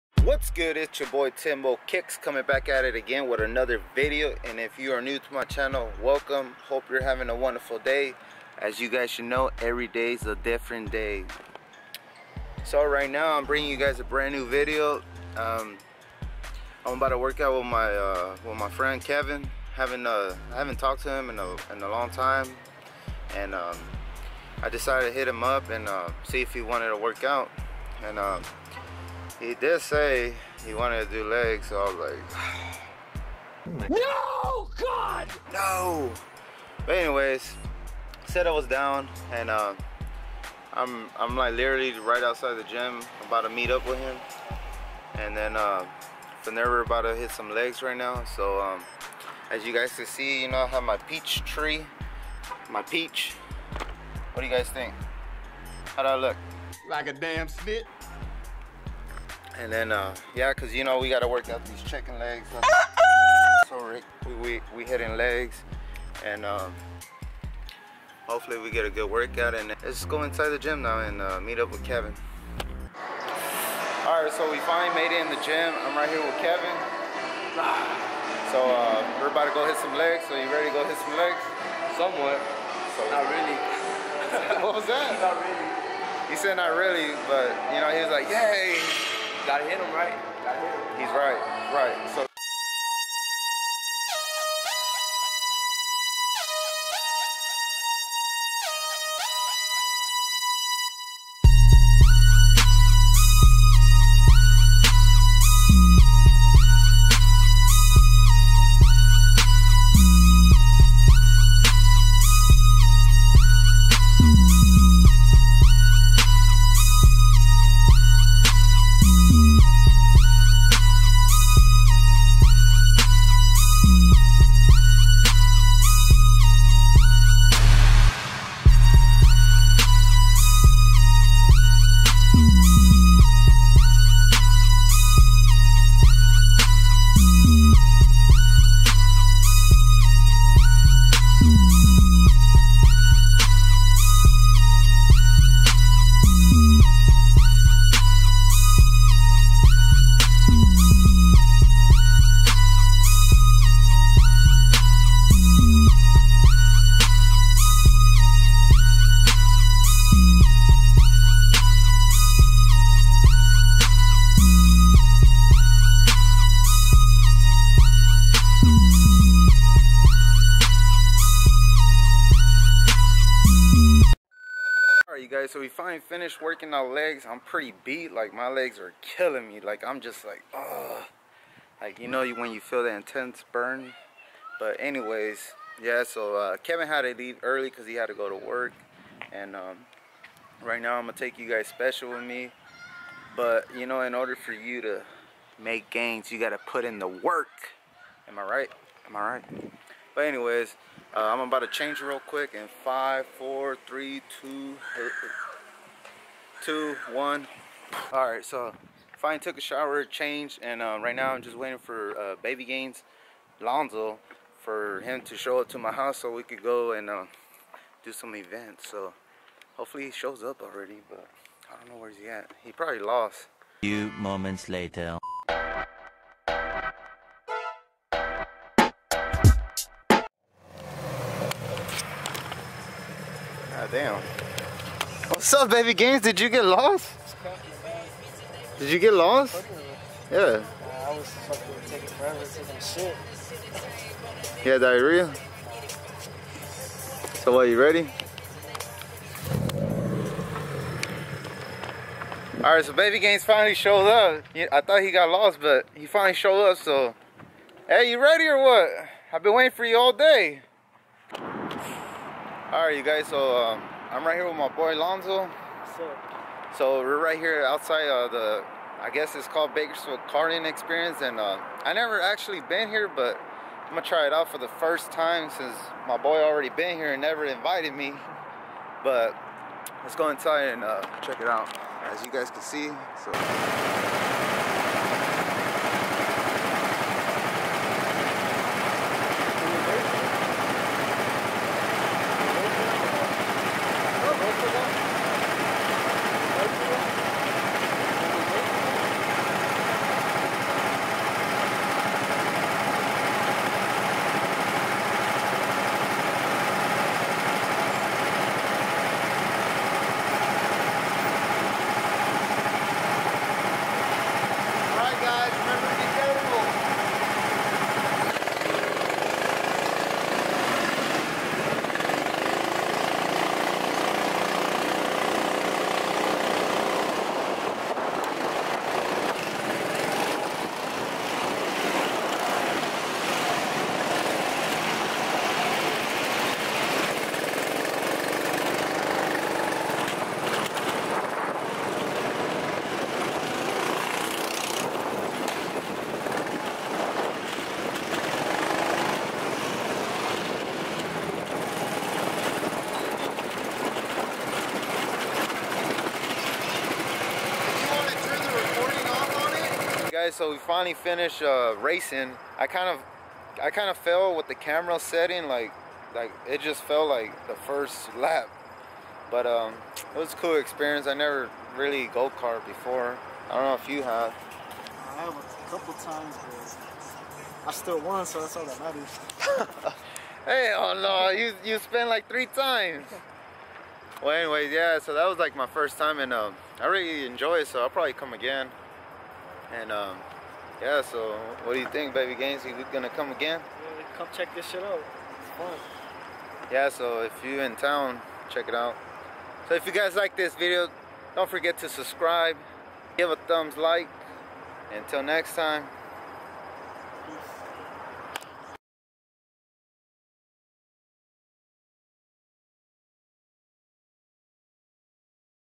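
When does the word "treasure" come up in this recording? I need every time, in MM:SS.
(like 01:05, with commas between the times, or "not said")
not said.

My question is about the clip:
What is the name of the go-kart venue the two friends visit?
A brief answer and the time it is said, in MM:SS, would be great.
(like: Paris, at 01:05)
Bakersfield Karting Experience, at 04:29.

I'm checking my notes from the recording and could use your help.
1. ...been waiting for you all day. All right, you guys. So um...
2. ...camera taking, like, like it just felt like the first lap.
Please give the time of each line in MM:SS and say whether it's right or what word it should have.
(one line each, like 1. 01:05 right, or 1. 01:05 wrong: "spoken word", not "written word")
1. 04:19 right
2. 06:04 wrong: "setting", not "taking".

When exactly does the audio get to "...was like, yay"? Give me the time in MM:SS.
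01:28.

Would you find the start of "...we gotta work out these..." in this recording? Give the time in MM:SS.
01:00.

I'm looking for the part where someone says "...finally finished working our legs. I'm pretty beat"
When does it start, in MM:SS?
02:55.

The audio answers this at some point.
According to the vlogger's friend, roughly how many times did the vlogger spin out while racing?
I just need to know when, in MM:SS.
06:22.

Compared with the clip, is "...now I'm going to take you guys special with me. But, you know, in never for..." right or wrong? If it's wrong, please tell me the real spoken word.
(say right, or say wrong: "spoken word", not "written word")
wrong: "order", not "never".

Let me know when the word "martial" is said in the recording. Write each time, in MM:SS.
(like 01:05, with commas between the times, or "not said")
not said.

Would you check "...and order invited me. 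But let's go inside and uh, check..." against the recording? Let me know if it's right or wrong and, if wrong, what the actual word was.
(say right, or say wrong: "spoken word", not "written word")
wrong: "never", not "order".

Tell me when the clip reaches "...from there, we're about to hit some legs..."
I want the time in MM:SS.
00:46.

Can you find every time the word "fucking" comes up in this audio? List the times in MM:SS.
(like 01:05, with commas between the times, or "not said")
04:01.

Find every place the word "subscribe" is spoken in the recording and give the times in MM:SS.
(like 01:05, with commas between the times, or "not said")
06:41.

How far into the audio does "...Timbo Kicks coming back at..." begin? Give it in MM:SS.
00:01.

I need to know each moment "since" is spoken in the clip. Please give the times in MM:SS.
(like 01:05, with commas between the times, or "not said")
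04:35.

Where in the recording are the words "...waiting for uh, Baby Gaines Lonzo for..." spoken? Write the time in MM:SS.
03:31.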